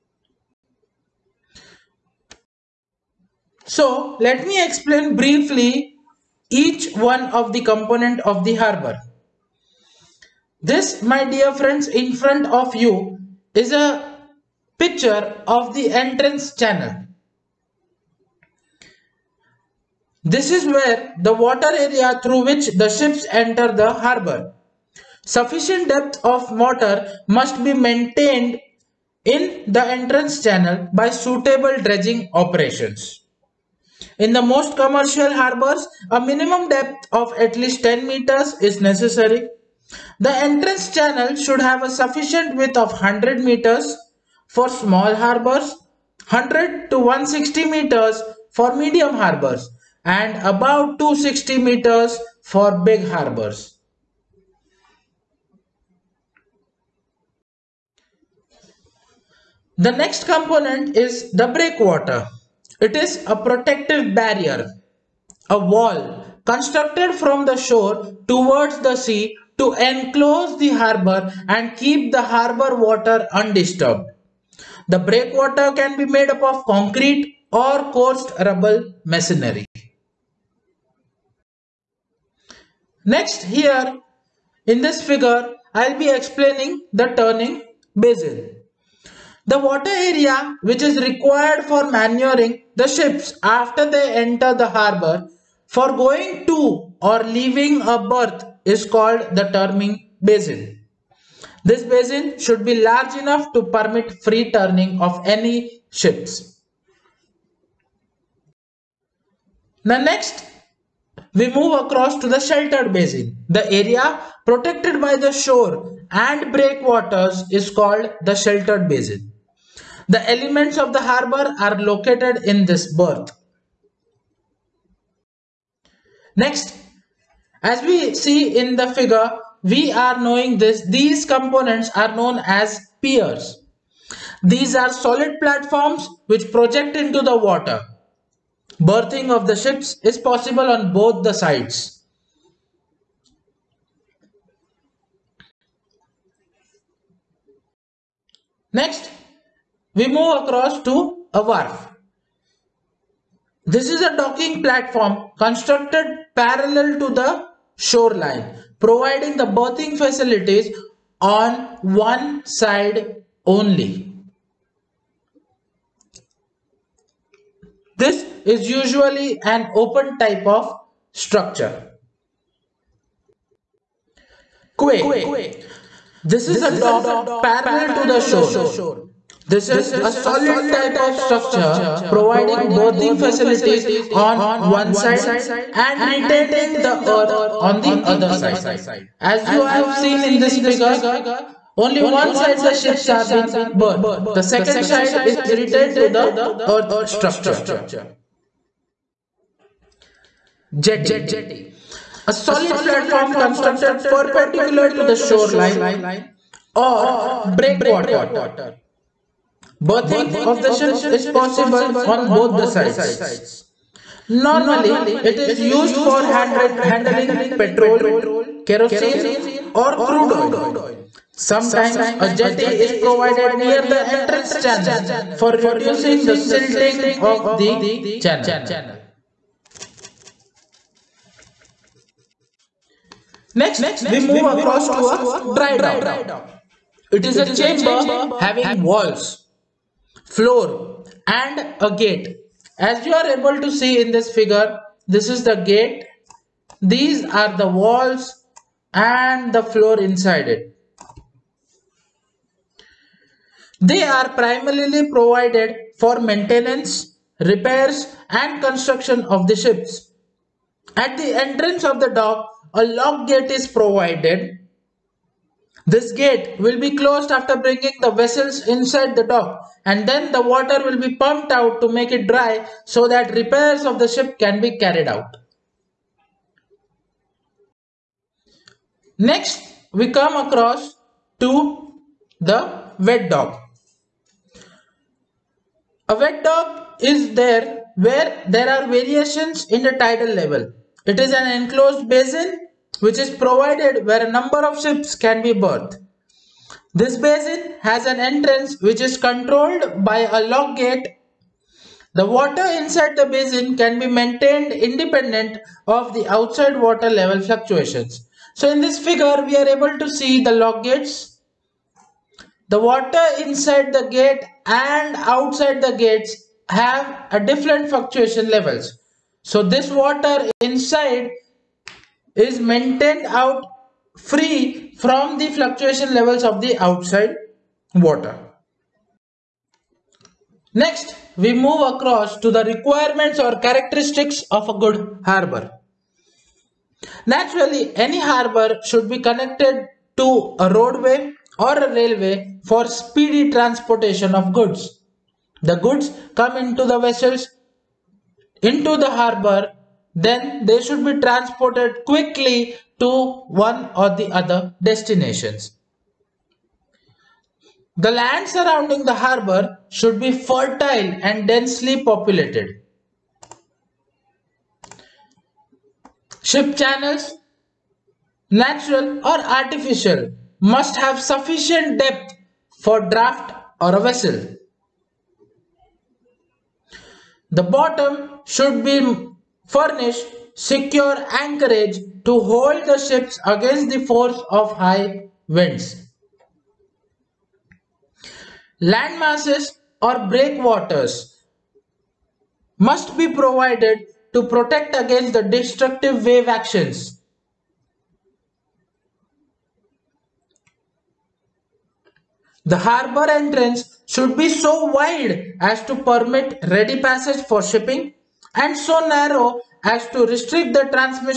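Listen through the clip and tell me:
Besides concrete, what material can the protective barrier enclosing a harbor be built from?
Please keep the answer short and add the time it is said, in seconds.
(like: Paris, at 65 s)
coursed rubble masonry, at 77 s.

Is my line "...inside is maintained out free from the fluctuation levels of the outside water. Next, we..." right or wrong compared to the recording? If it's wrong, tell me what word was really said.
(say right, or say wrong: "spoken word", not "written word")
right.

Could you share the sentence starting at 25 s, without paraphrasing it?
Sufficient depth of water must be maintained in the entrance channel by suitable dredging operations.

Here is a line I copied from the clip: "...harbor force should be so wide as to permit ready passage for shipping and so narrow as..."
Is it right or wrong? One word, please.
wrong.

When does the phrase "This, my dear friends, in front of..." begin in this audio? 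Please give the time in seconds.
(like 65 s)
10 s.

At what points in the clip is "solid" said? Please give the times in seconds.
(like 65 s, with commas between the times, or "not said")
134 s, 180 s, 202 s.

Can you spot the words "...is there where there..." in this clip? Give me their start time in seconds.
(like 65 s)
287 s.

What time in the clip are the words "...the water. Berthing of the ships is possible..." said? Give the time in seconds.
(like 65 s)
137 s.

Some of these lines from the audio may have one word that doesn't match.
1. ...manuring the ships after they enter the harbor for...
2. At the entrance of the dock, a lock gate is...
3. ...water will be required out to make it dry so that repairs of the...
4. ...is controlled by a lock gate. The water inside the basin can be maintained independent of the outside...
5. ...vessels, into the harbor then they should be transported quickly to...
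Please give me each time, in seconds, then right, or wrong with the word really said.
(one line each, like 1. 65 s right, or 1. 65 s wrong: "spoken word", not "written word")
1. 91 s right
2. 260 s right
3. 270 s wrong: "pumped", not "required"
4. 299 s right
5. 346 s right.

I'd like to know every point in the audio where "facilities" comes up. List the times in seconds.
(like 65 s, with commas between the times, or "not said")
159 s, 183 s.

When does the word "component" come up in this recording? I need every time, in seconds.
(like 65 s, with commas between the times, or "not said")
7 s, 60 s, 131 s.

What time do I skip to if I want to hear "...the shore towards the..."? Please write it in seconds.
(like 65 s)
67 s.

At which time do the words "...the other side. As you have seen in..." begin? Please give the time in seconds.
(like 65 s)
187 s.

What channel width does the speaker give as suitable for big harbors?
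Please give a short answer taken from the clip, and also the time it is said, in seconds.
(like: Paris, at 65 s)
260 meters, at 50 s.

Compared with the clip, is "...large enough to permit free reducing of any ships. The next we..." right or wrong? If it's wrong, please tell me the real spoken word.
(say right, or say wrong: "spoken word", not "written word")
wrong: "turning", not "reducing".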